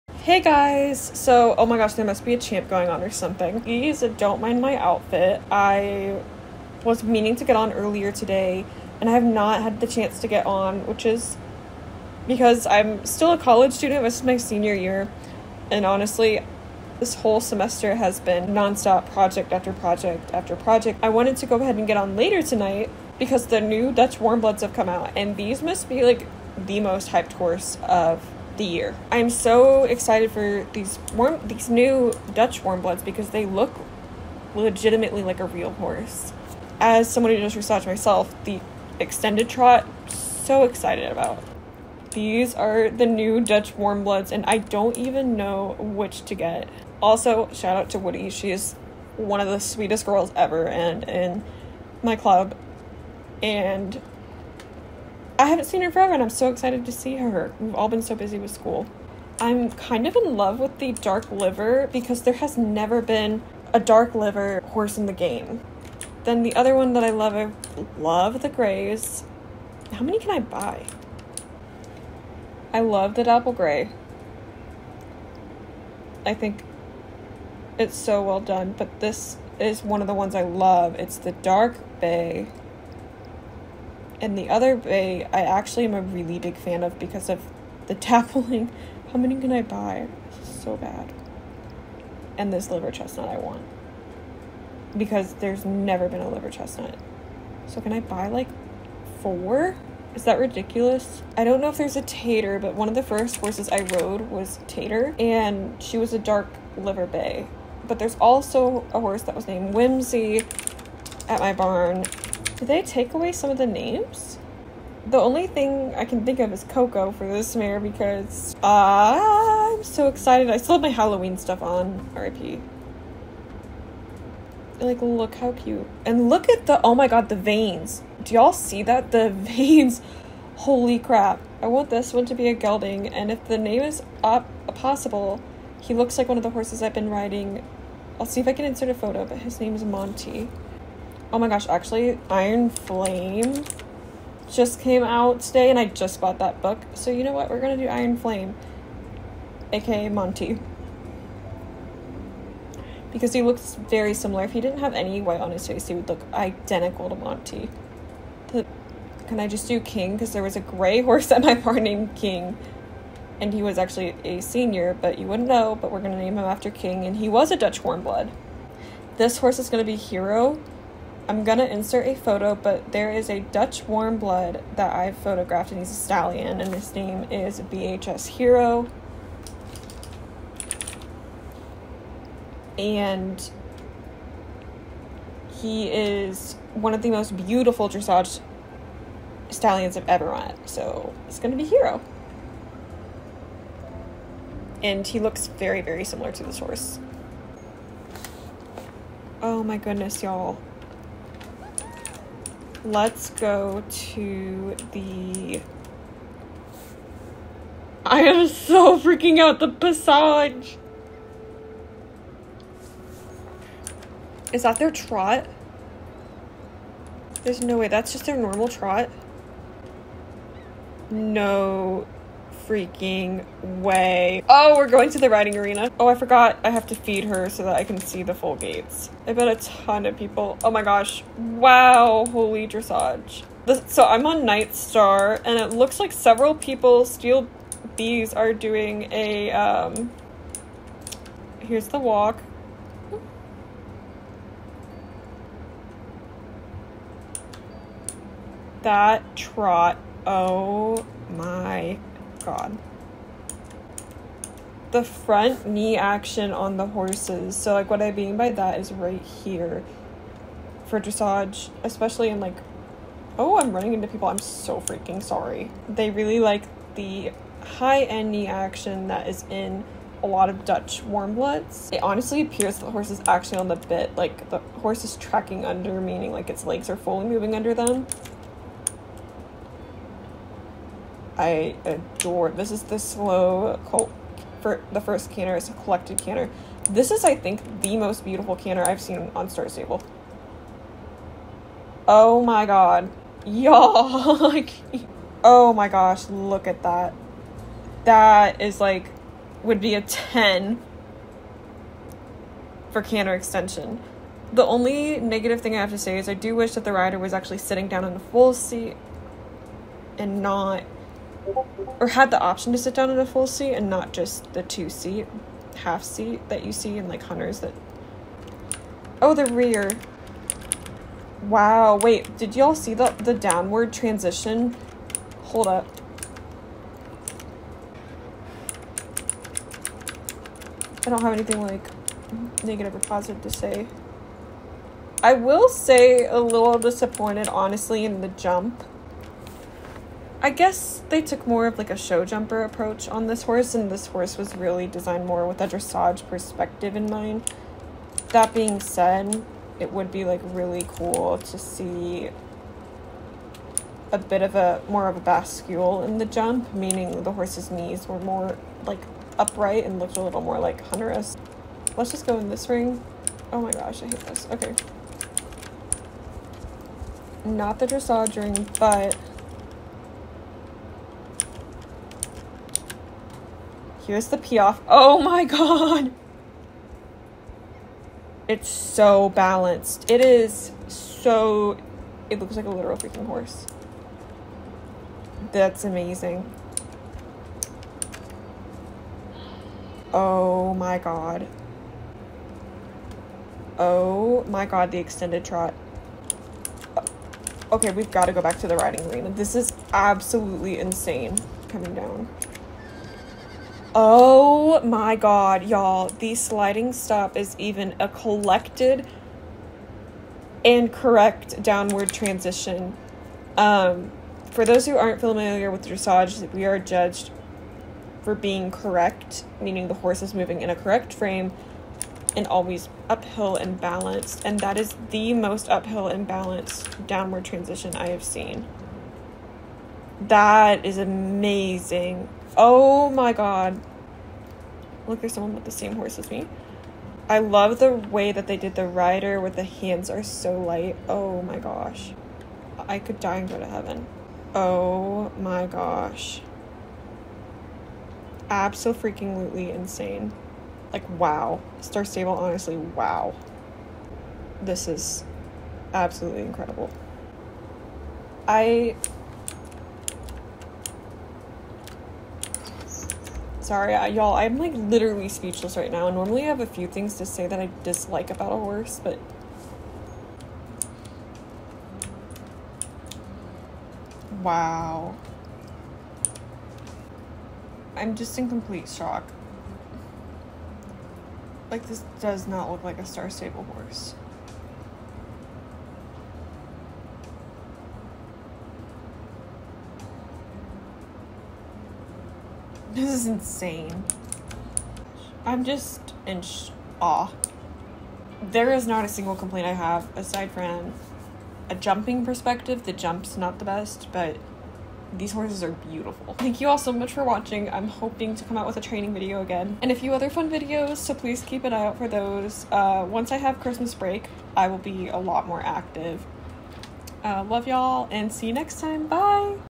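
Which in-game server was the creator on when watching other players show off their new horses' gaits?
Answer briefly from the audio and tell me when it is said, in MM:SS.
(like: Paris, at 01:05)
Night Star, at 03:54.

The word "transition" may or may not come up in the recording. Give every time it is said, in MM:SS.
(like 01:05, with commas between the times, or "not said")
05:23, 06:52, 07:07.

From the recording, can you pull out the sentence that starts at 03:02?
And he is one of the most beautiful dressage stallions I've ever met, so it's gonna be Hero.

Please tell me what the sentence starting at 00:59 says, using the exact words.
I'm kind of in love with the dark liver because there has never been a dark liver horse in the game.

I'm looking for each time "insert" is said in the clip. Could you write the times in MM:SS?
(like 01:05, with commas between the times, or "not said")
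02:18, 02:51.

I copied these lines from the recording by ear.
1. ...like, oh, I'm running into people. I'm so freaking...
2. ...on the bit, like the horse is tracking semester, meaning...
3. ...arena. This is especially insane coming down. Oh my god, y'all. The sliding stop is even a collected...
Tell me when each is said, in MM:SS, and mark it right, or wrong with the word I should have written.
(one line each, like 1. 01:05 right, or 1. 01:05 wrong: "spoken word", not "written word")
1. 04:22 right
2. 04:33 wrong: "under", not "semester"
3. 06:39 wrong: "absolutely", not "especially".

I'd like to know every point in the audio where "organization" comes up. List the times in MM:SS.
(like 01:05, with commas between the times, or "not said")
not said.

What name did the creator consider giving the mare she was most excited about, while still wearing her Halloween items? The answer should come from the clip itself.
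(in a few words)
Coco.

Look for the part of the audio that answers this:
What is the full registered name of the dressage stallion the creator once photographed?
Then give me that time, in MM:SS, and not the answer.
02:57.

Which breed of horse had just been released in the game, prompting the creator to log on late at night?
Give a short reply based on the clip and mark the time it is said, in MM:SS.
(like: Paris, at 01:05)
Dutch Warmbloods, at 00:23.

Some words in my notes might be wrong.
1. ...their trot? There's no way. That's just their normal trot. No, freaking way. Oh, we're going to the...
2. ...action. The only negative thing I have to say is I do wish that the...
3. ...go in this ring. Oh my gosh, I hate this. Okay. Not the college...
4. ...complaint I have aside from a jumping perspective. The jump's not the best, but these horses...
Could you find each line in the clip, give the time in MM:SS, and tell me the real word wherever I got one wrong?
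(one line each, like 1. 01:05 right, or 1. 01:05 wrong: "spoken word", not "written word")
1. 03:34 right
2. 05:03 wrong: "extension", not "action"
3. 06:02 wrong: "dressage", not "college"
4. 08:19 right.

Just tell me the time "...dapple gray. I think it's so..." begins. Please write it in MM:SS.
01:13.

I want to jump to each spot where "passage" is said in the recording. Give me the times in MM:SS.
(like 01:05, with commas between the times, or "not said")
03:29.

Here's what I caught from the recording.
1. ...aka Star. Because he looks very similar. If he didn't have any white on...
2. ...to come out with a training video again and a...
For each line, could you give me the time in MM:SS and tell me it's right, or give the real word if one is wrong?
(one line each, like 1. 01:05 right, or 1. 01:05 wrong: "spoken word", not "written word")
1. 02:29 wrong: "Monty", not "Star"
2. 08:28 right.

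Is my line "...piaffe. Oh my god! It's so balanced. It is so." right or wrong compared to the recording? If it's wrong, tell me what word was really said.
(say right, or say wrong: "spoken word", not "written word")
right.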